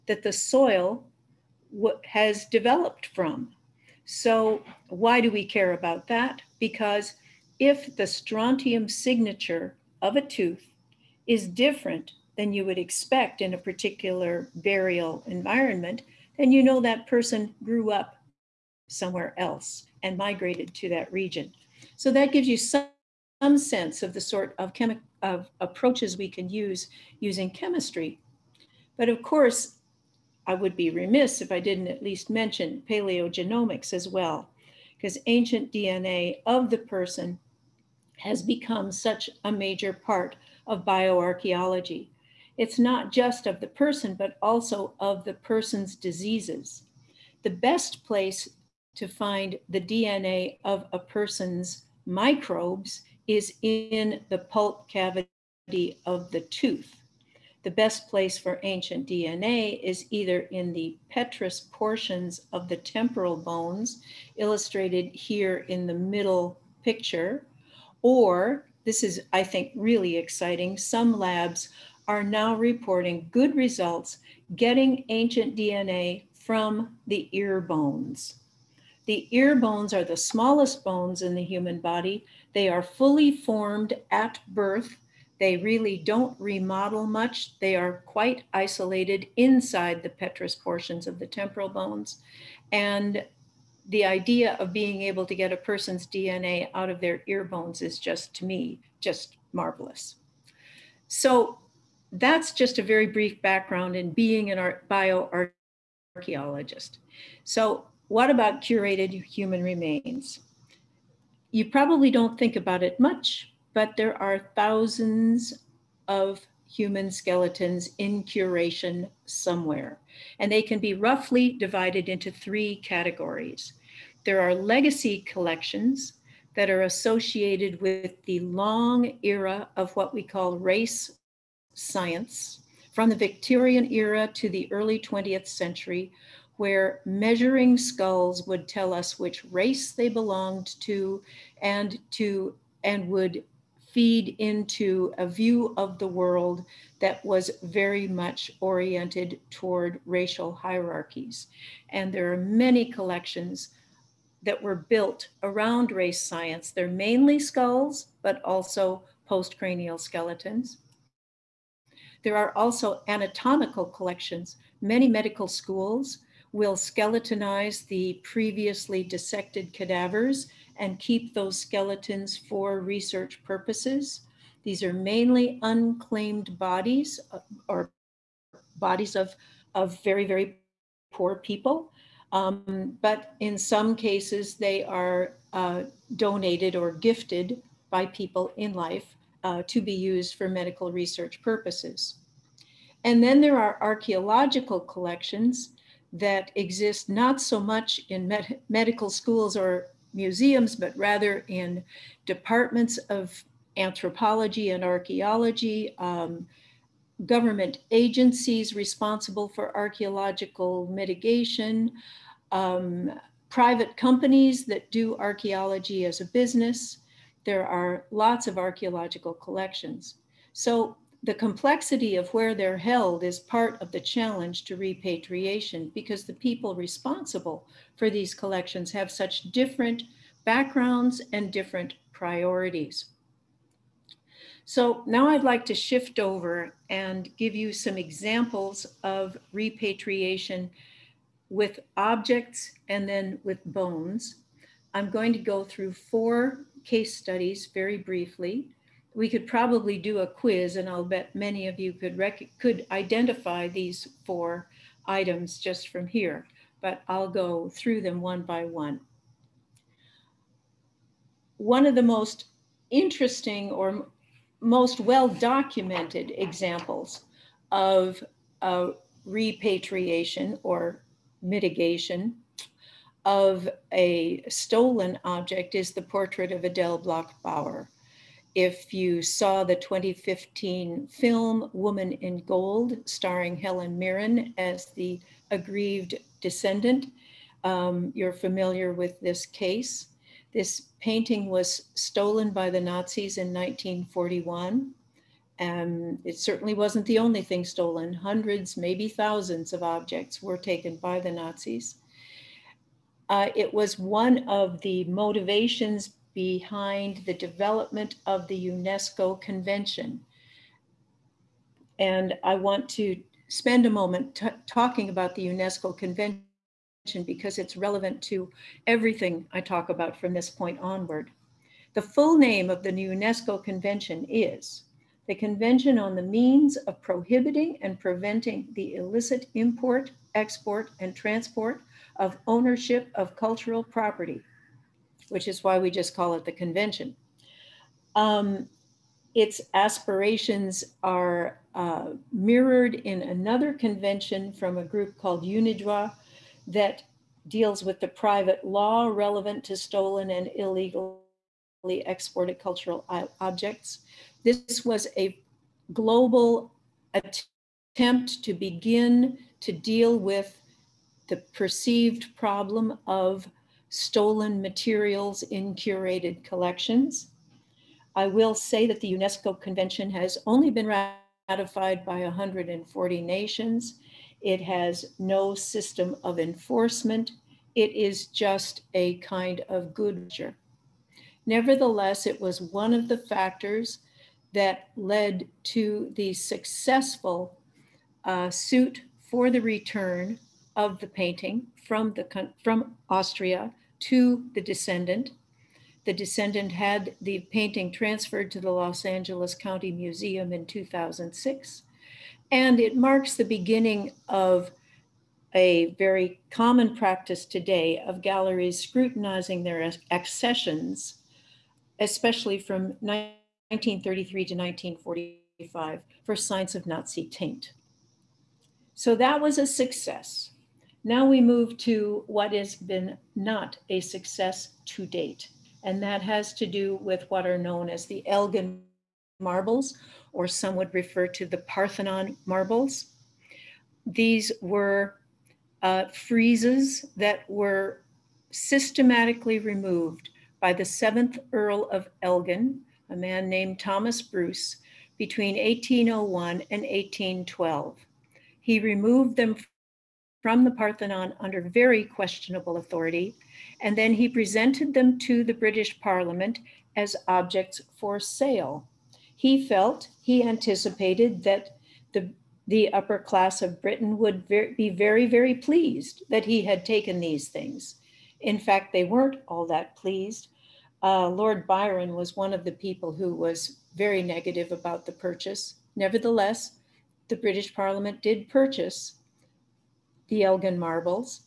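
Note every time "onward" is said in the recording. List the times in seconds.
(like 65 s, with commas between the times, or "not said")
320 s.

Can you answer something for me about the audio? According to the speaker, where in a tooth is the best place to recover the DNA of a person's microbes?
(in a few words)
Pulp cavity.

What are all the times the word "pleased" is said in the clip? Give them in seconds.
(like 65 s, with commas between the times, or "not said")
465 s, 469 s.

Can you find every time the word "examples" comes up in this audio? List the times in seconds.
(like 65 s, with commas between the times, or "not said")
237 s, 266 s.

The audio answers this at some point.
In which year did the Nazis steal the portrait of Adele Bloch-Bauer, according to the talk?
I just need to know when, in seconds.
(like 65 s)
293 s.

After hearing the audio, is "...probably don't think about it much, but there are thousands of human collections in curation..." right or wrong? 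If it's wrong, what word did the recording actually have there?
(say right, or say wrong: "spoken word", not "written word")
wrong: "skeletons", not "collections".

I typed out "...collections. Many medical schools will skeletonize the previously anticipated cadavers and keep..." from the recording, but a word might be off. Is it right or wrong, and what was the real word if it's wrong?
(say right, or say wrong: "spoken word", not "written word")
wrong: "dissected", not "anticipated".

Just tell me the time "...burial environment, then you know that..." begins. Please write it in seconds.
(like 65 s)
14 s.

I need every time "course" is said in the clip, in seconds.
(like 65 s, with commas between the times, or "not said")
29 s.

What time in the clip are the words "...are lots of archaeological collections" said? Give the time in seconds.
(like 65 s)
217 s.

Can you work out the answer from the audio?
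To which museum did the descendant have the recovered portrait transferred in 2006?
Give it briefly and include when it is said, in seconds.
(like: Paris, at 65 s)
Los Angeles County Museum, at 398 s.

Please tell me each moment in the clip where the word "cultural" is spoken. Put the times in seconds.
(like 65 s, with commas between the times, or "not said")
333 s, 352 s.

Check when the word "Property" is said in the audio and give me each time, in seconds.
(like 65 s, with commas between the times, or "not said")
333 s.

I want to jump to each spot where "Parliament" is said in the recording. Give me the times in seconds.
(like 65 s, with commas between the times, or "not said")
456 s, 477 s.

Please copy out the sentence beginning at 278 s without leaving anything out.
If you saw the 2015 film Woman in Gold, starring Helen Mirren as the aggrieved descendant, um, you're familiar with this case.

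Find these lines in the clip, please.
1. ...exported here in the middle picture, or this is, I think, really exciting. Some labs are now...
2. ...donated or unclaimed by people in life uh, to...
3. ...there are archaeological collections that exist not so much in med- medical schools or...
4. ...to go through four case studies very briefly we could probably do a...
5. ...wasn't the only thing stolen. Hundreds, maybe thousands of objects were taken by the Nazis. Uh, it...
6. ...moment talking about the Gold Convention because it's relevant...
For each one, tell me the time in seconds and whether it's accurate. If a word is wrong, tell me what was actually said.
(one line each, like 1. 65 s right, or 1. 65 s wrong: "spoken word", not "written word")
1. 64 s wrong: "illustrated", not "exported"
2. 186 s wrong: "gifted", not "unclaimed"
3. 193 s right
4. 245 s right
5. 296 s right
6. 313 s wrong: "UNESCO", not "Gold".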